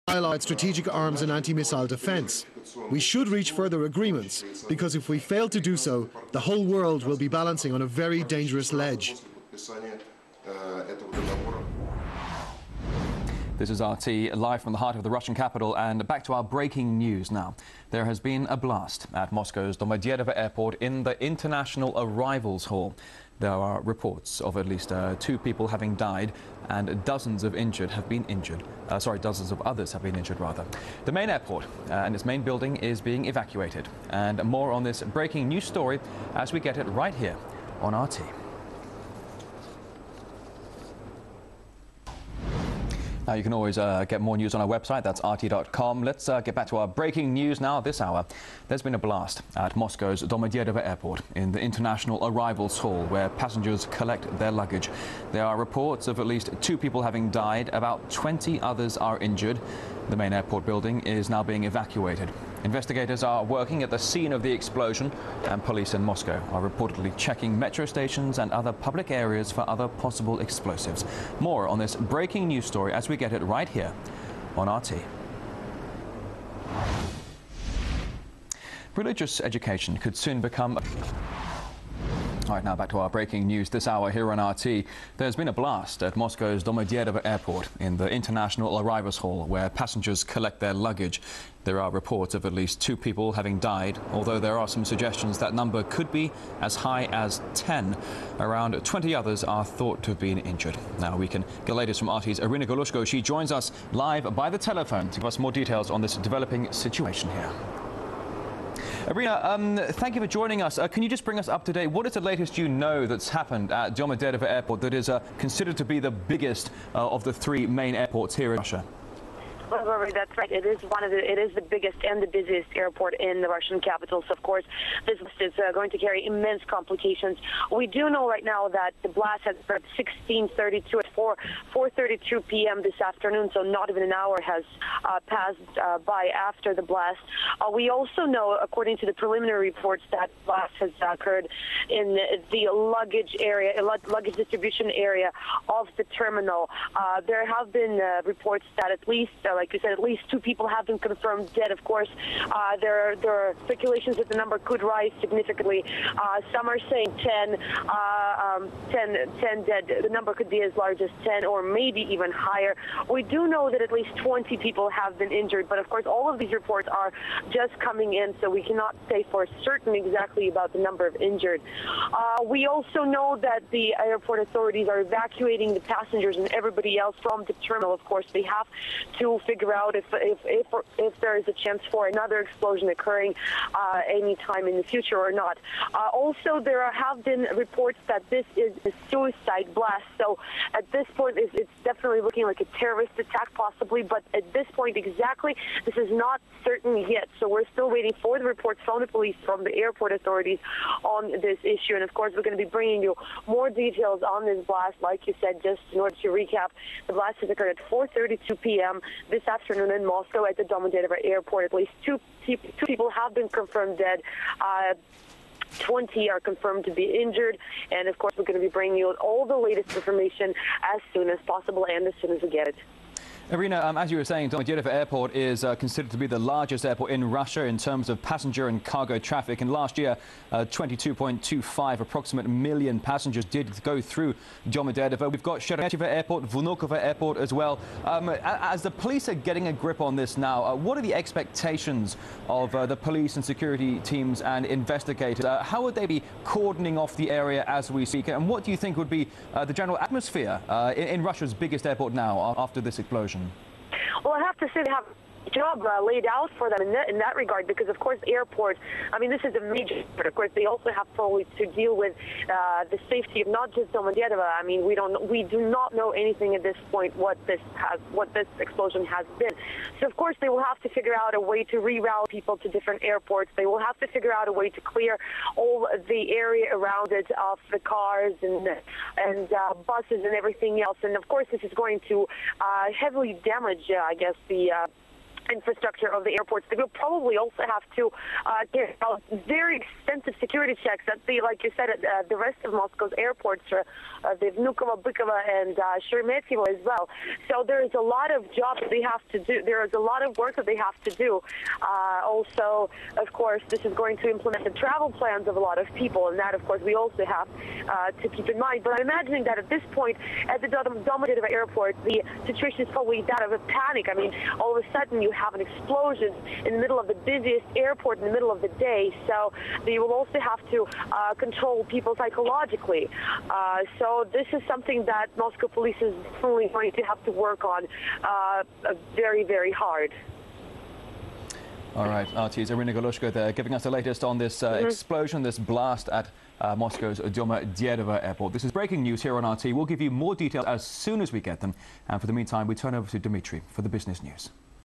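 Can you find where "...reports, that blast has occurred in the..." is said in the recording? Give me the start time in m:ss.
2:19.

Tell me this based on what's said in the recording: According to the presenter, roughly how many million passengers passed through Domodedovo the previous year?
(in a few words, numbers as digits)
22.25 million.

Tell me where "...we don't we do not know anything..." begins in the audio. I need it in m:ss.
4:24.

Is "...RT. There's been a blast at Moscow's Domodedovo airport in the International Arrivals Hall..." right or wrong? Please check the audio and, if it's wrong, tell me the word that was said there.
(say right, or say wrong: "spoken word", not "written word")
right.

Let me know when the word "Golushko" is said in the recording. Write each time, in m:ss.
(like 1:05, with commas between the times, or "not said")
1:42, 5:32.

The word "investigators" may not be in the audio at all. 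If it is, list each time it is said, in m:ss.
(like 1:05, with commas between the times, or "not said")
1:02, 4:04.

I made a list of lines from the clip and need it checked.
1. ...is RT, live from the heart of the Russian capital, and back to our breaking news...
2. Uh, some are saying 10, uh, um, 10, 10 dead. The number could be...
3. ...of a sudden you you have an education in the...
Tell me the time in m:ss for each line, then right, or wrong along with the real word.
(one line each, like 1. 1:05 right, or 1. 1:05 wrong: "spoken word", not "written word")
1. 0:13 right
2. 2:36 right
3. 5:14 wrong: "explosion", not "education".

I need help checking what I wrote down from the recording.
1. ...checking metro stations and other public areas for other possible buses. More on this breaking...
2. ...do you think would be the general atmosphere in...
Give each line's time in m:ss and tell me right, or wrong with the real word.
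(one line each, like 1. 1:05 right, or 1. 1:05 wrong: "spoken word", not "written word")
1. 1:07 wrong: "explosives", not "buses"
2. 4:08 right.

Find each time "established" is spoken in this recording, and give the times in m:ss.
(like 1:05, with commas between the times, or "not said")
not said.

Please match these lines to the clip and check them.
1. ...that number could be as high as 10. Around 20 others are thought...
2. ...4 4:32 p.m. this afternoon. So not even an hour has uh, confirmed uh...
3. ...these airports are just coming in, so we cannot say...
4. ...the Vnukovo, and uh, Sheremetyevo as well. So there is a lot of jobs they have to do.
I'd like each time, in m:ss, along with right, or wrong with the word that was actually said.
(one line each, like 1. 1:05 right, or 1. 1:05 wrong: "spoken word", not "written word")
1. 1:35 right
2. 2:11 wrong: "passed", not "confirmed"
3. 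2:46 wrong: "reports", not "airports"
4. 4:54 right.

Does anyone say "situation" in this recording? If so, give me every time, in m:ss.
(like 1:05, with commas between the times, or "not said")
1:46, 5:12.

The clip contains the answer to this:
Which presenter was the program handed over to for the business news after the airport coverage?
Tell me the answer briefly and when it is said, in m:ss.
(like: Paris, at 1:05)
Dmitry, at 5:43.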